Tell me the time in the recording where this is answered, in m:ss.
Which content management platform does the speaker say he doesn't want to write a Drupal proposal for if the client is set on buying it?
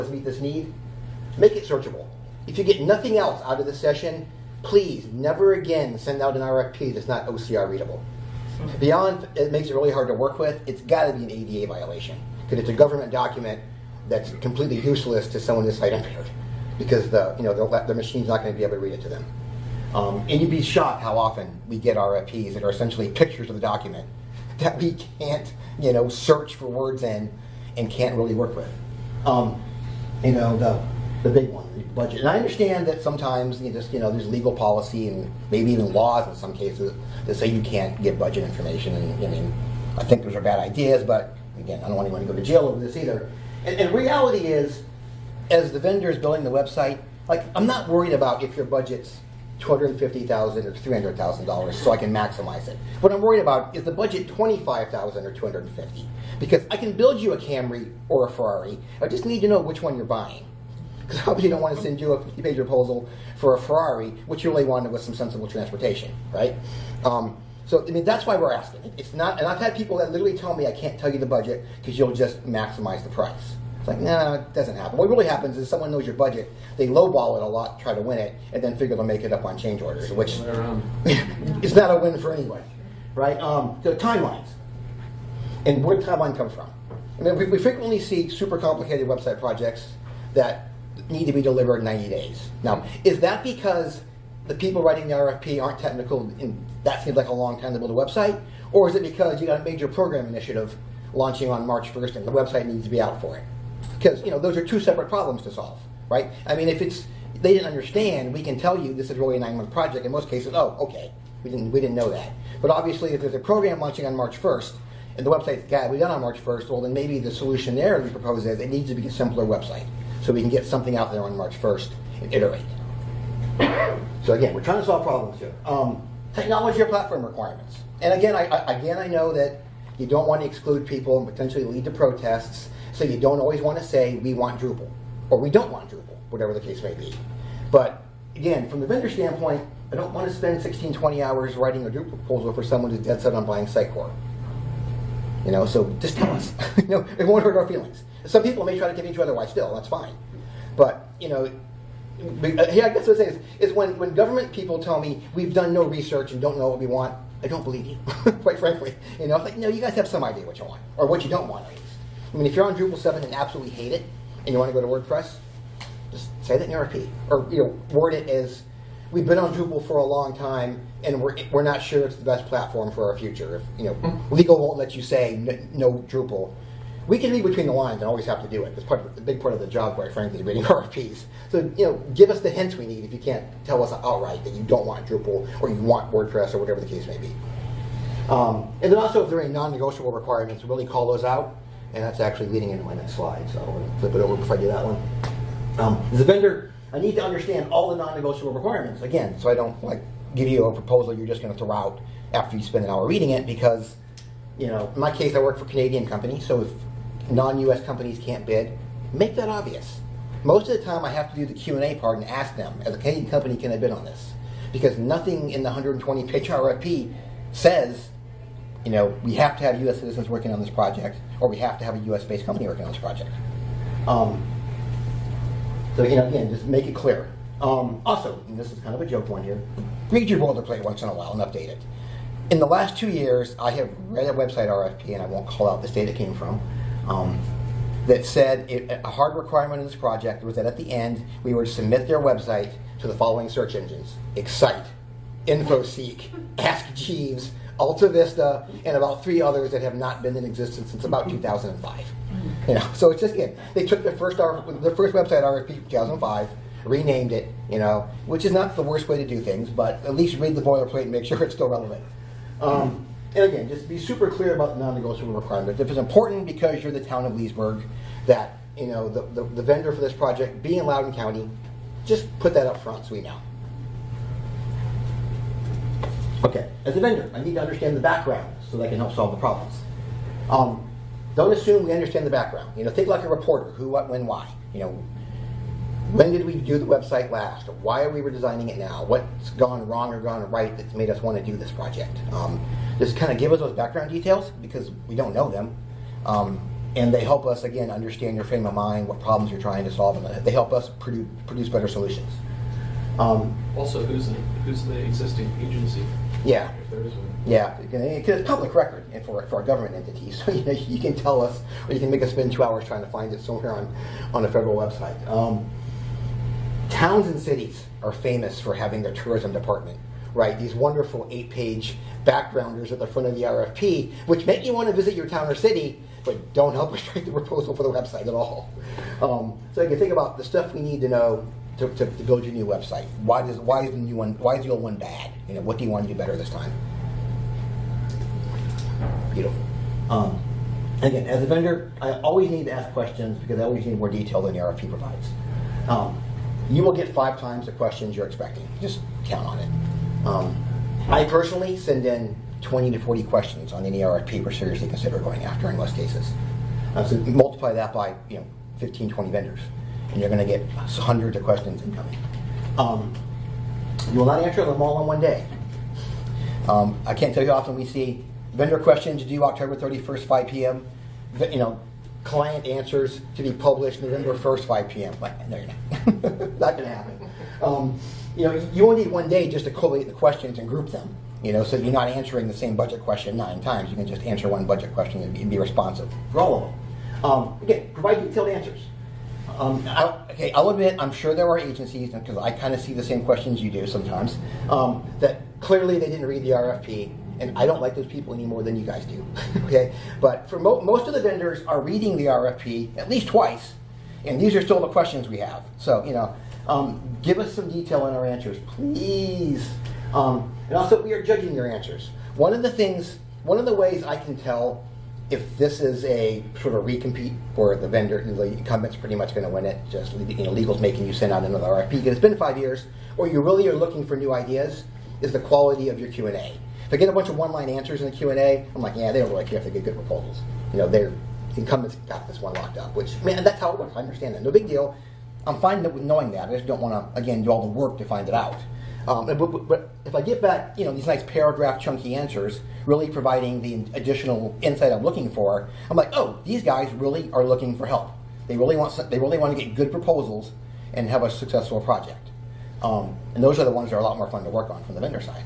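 2:23.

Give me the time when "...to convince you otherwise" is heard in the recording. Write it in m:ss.
2:28.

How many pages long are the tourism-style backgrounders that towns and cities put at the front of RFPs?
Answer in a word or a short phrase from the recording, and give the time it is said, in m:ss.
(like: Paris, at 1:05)
8, at 5:21.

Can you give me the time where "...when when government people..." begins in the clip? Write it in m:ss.
2:33.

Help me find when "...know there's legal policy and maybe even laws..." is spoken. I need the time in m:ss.
0:33.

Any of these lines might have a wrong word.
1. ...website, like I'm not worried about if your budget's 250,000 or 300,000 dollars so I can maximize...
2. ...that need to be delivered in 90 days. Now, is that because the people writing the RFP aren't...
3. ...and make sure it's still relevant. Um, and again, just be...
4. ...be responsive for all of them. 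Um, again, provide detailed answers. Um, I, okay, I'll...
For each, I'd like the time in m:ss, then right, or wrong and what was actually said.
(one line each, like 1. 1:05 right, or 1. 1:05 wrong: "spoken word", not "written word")
1. 0:46 right
2. 1:30 right
3. 4:21 right
4. 6:25 right.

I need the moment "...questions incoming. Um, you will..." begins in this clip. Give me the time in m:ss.
6:01.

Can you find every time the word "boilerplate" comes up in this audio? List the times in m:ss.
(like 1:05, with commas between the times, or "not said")
3:50, 4:20.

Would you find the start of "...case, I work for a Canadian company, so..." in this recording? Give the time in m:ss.
3:25.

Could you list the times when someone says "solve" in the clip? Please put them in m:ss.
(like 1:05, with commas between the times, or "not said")
1:45, 2:04, 4:39, 4:59.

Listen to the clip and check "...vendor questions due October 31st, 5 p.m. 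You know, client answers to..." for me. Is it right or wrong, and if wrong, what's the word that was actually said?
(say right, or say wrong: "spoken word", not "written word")
right.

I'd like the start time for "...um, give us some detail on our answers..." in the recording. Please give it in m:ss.
6:46.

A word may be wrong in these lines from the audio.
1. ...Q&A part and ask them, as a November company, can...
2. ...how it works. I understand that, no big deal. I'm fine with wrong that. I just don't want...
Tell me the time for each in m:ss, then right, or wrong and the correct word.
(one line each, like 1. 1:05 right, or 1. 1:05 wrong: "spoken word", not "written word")
1. 3:31 wrong: "Canadian", not "November"
2. 7:13 wrong: "knowing", not "wrong".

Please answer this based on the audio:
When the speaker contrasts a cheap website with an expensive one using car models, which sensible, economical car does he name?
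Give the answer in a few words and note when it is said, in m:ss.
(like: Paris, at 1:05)
Camry, at 0:57.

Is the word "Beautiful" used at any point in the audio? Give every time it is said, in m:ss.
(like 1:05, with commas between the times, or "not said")
5:39.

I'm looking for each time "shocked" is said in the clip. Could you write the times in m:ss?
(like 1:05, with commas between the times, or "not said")
0:20.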